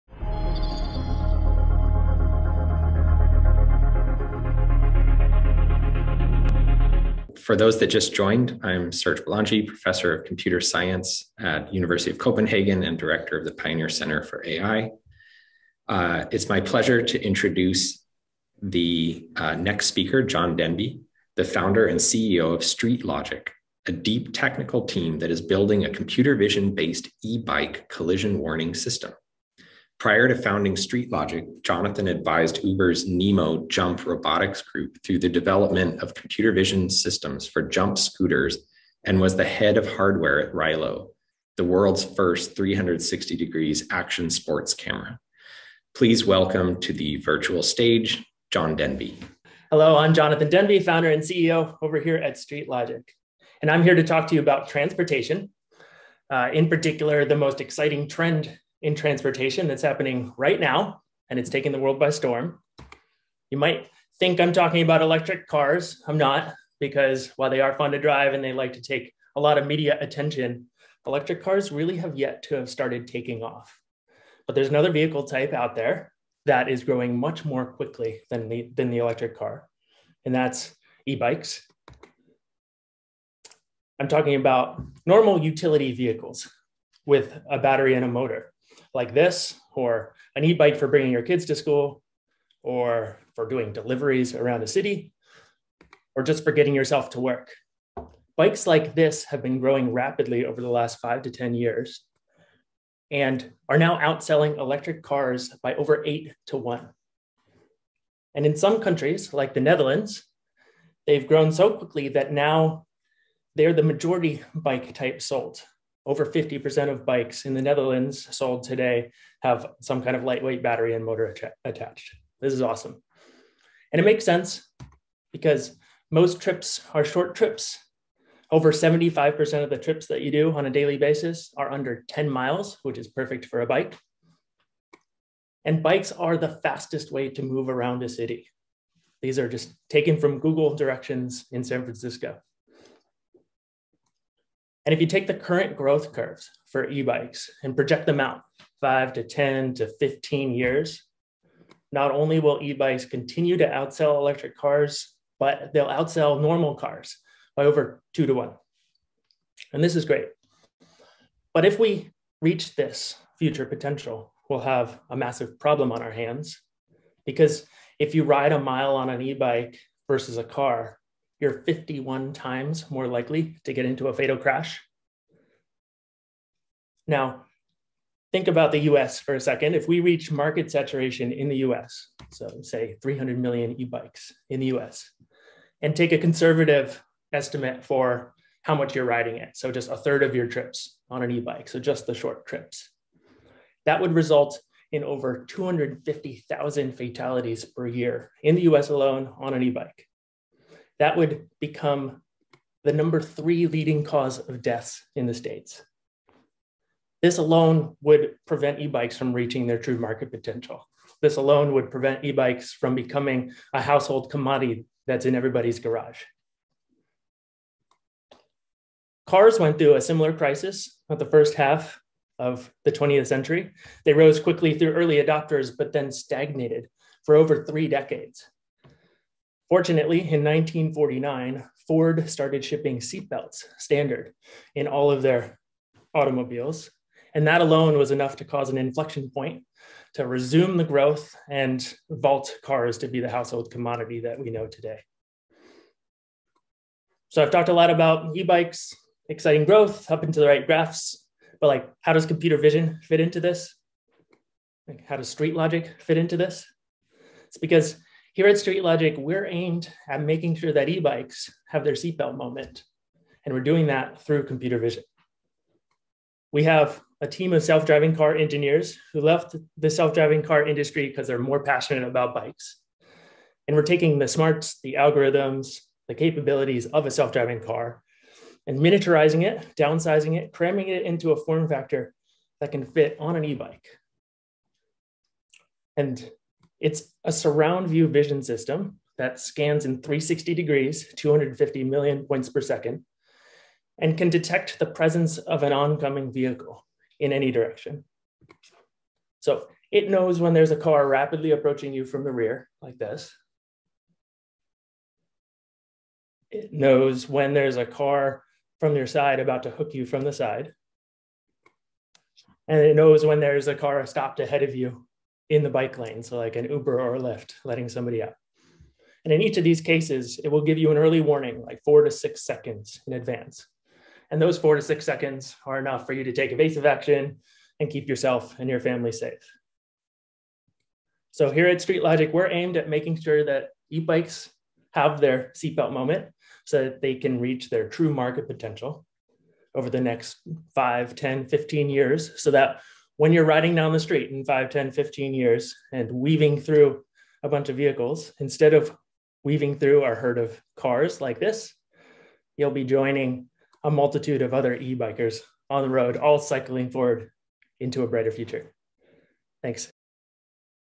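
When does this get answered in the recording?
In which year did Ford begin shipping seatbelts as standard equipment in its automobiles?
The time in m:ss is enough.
3:50.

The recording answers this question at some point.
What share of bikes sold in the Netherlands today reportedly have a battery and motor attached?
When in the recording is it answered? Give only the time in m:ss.
1:56.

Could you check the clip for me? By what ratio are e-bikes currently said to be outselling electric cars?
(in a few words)
8 to 1.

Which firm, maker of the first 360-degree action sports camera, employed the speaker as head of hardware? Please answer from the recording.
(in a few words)
Rylo.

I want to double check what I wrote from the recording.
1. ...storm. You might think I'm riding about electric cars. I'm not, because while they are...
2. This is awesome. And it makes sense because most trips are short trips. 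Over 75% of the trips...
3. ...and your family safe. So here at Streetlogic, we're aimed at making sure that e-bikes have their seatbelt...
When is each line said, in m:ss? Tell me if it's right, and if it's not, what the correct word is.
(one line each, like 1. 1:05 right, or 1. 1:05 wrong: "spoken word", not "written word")
1. 1:02 wrong: "talking", not "riding"
2. 2:02 right
3. 5:28 right.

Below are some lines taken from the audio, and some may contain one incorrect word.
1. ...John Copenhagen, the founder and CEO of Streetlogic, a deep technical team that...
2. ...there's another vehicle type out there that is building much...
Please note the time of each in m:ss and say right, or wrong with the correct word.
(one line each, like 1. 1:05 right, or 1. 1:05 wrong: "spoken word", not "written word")
1. 0:20 wrong: "Denby", not "Copenhagen"
2. 1:14 wrong: "growing", not "building".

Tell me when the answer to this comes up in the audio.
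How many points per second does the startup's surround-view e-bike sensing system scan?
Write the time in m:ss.
4:51.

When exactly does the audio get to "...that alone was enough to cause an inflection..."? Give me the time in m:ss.
3:57.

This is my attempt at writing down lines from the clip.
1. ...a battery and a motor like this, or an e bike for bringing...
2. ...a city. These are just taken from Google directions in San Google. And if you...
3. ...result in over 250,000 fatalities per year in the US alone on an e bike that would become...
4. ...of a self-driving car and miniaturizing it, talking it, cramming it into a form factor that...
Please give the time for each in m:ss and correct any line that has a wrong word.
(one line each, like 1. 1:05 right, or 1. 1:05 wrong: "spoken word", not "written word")
1. 1:27 right
2. 2:18 wrong: "Francisco", not "Google"
3. 3:14 right
4. 4:36 wrong: "downsizing", not "talking".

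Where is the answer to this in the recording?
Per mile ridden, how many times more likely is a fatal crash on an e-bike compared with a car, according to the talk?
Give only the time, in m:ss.
2:51.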